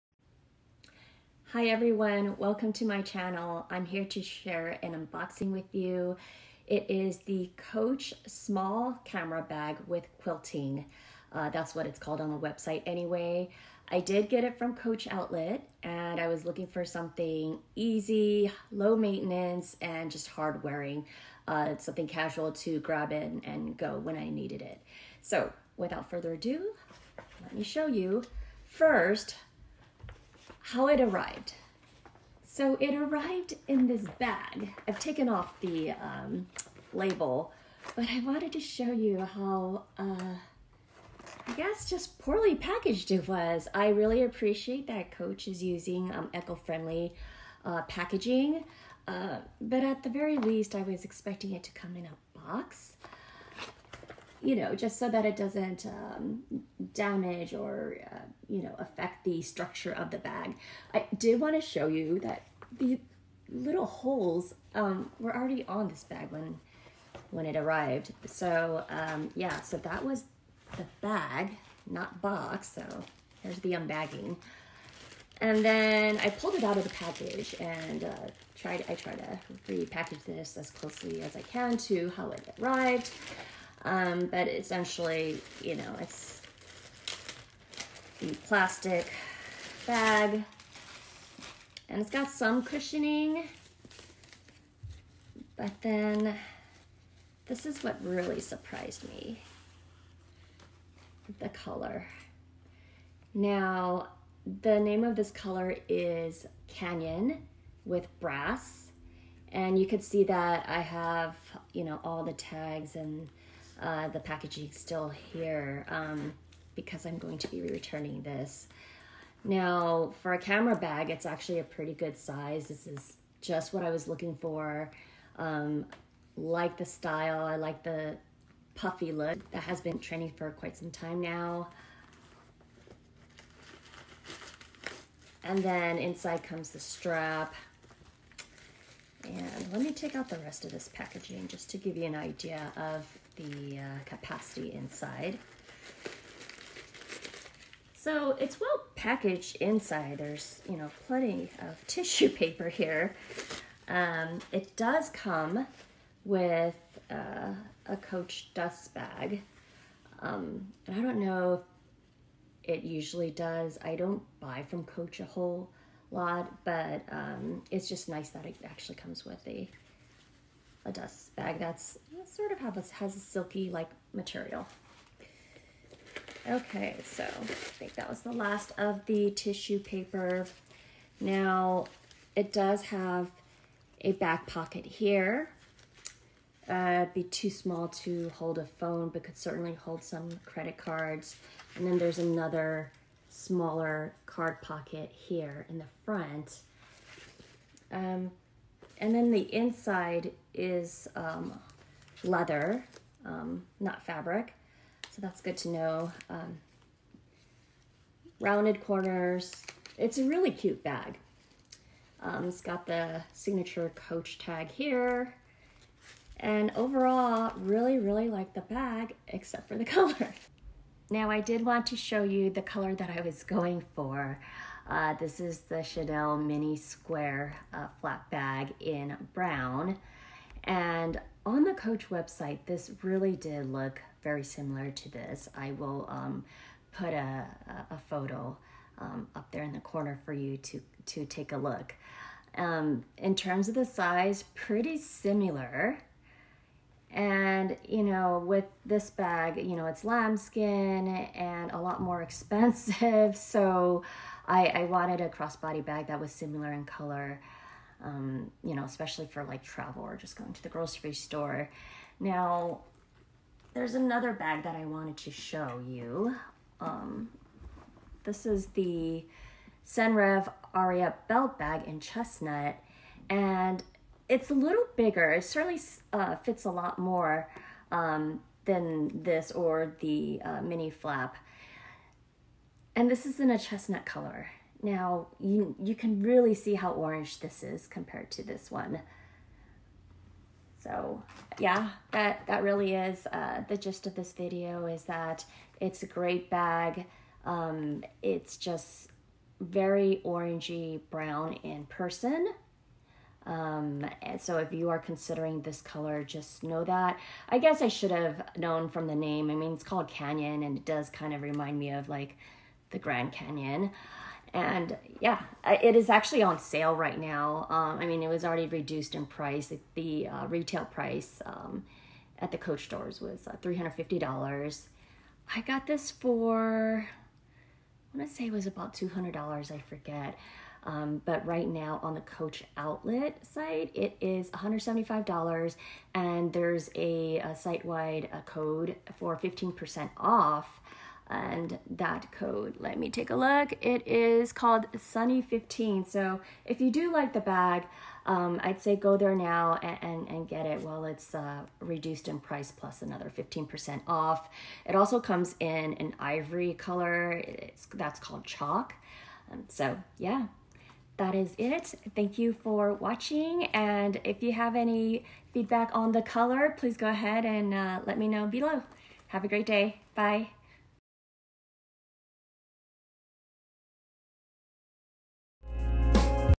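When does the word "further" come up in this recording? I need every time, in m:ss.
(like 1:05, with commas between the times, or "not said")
0:26.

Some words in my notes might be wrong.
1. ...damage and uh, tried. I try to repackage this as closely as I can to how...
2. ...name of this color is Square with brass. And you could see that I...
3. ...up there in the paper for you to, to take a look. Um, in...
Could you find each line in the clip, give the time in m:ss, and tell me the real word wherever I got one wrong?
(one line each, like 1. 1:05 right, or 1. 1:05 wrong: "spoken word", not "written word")
1. 1:16 wrong: "package", not "damage"
2. 1:44 wrong: "Canyon", not "Square"
3. 3:59 wrong: "corner", not "paper".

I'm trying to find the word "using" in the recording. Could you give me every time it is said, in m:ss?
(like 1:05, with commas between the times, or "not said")
0:45.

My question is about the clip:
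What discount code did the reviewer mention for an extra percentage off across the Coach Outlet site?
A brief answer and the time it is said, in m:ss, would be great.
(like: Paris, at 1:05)
Sunny15, at 5:44.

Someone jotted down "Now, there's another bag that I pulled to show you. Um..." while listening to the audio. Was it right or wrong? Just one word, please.
wrong.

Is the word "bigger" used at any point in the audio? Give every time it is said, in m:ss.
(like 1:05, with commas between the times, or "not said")
4:34.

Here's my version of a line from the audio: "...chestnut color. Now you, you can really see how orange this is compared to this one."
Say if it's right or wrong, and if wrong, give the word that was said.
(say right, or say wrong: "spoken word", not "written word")
right.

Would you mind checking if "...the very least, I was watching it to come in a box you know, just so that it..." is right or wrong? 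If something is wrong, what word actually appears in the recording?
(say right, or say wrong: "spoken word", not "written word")
wrong: "expecting", not "watching".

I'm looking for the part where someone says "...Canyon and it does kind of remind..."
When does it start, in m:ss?
5:10.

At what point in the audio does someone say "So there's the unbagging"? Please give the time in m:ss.
1:12.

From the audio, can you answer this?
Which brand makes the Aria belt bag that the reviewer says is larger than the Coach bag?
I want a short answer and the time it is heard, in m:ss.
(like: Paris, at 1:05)
Senreve, at 4:29.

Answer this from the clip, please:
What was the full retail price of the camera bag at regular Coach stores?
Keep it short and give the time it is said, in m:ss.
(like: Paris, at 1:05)
$350, at 5:23.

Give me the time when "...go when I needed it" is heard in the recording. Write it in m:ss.
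0:23.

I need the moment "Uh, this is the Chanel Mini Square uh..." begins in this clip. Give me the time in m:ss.
3:44.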